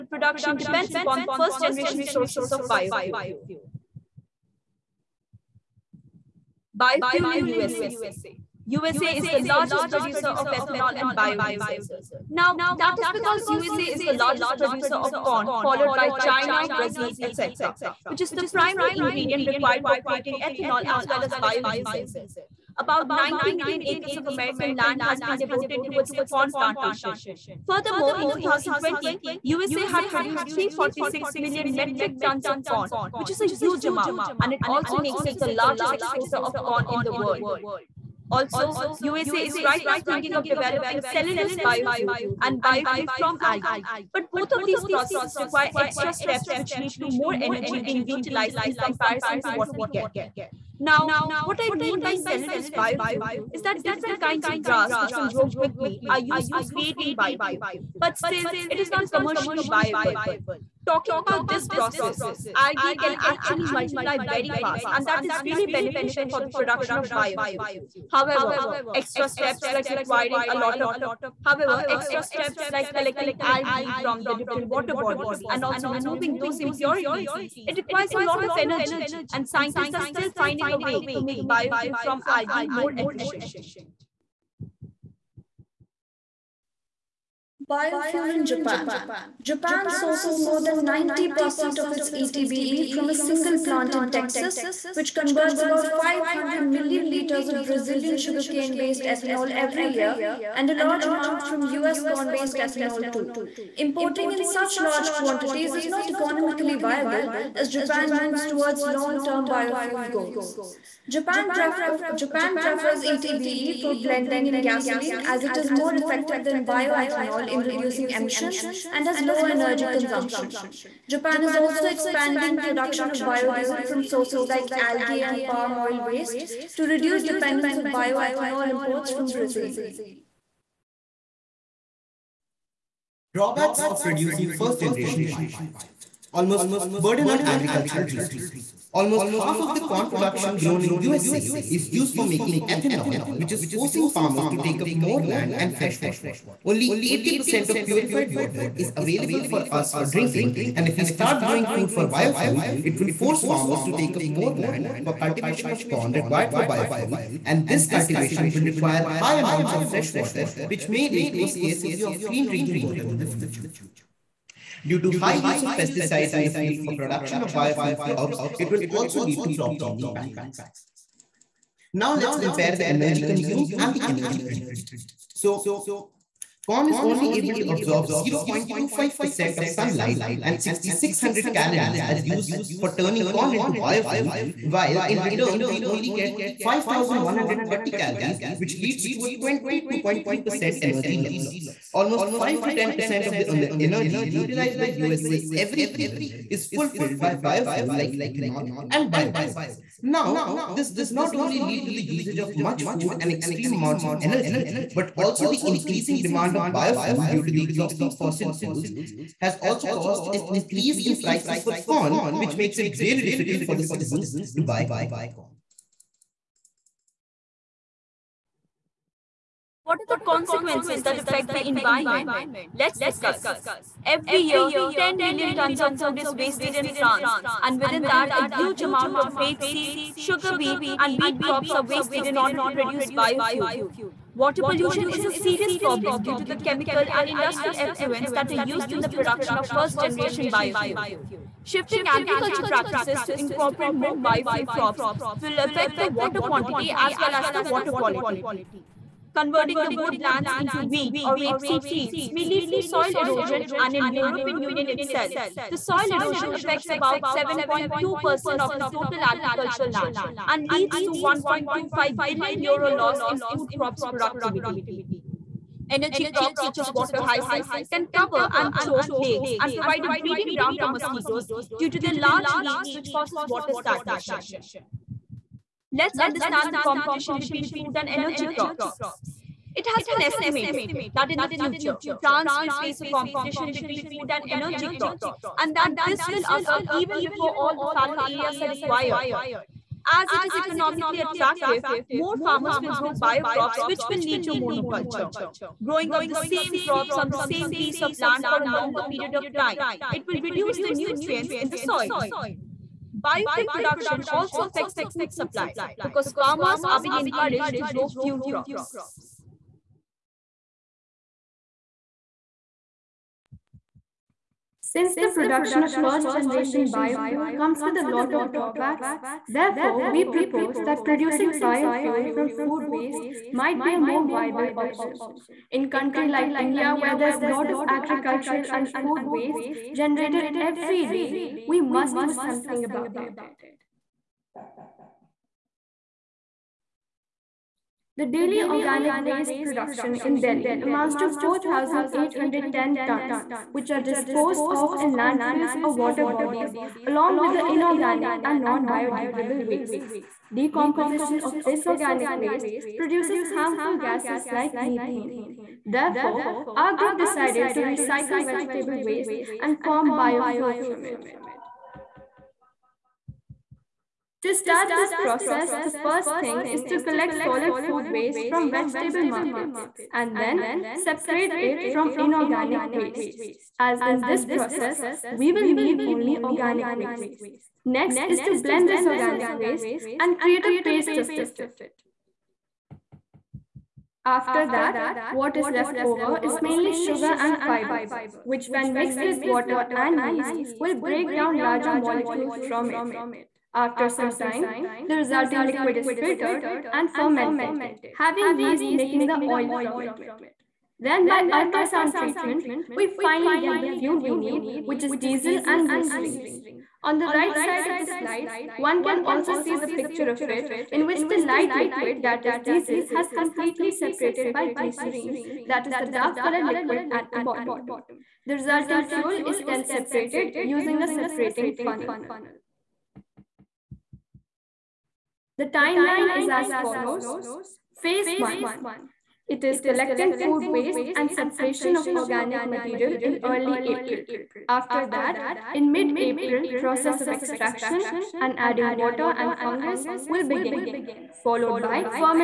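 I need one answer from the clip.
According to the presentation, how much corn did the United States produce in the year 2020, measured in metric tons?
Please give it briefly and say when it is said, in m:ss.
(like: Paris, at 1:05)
346 million metric tons, at 0:30.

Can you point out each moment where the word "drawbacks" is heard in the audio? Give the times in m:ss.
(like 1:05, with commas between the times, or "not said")
2:13, 5:18.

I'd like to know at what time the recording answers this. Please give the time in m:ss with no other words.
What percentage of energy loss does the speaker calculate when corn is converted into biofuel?
3:09.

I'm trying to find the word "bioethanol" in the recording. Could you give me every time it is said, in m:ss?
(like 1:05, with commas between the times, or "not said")
1:56, 2:07.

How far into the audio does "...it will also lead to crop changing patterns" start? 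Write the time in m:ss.
2:48.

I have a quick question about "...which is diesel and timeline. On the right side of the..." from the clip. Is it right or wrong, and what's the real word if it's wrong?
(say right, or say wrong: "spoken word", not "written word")
wrong: "glycerine", not "timeline".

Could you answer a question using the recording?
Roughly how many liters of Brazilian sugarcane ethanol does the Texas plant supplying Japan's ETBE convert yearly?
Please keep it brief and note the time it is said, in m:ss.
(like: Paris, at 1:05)
500 million liters, at 1:35.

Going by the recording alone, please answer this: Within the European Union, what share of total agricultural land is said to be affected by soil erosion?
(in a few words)
7.2%.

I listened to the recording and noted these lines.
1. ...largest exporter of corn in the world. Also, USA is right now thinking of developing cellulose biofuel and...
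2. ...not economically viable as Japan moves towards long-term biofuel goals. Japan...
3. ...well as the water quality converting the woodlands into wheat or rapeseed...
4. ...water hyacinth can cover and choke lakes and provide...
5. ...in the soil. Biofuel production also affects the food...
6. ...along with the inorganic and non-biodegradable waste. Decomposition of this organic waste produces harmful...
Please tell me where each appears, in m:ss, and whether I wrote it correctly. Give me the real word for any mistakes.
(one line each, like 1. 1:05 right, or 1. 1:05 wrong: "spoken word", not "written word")
1. 0:35 right
2. 1:45 right
3. 4:07 right
4. 4:26 right
5. 5:01 right
6. 5:47 right.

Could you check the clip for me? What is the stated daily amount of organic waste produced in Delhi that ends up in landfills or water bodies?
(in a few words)
4,810 tons.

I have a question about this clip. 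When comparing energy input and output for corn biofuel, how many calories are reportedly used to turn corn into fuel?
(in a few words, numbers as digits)
6,600 calories.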